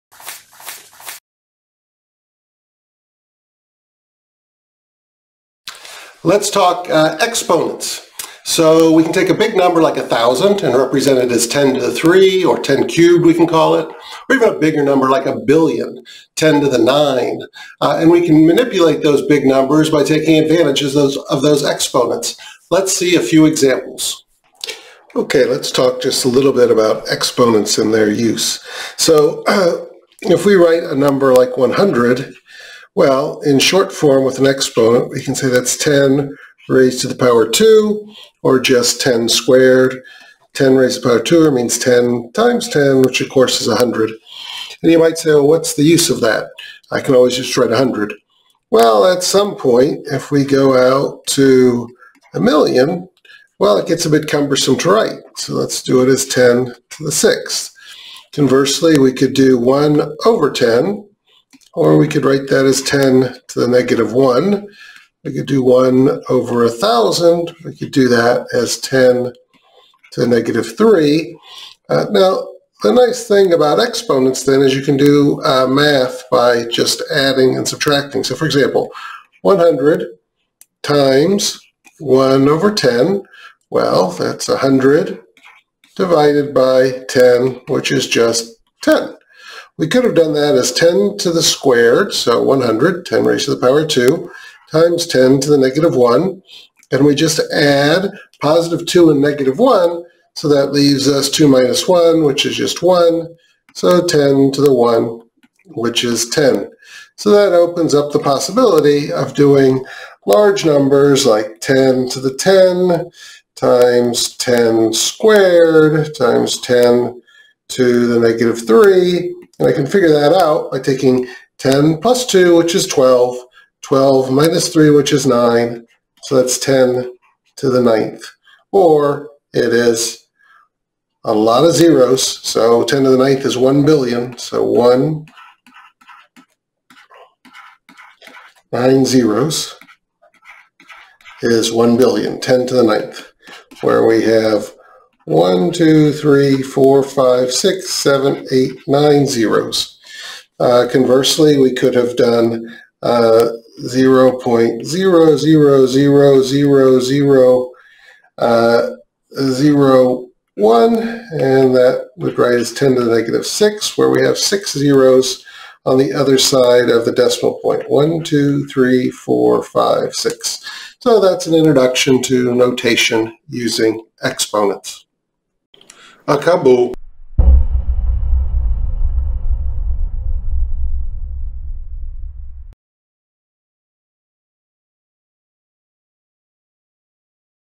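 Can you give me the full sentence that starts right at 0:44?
And you might say, well, what's the use of that?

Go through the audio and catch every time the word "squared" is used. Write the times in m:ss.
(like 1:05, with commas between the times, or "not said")
0:39, 1:31, 1:54.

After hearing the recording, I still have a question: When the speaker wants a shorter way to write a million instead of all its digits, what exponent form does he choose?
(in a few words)
10 to the 6th.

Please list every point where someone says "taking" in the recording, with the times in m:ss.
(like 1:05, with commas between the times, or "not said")
0:20, 2:00.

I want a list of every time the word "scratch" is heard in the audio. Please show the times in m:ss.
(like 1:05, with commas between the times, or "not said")
not said.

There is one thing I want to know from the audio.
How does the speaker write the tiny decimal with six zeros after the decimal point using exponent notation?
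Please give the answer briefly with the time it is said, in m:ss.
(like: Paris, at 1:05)
10 to the -6, at 2:42.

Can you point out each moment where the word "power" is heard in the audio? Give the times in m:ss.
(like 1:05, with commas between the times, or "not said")
0:37, 0:41, 1:33.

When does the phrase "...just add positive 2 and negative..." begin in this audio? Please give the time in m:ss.
1:37.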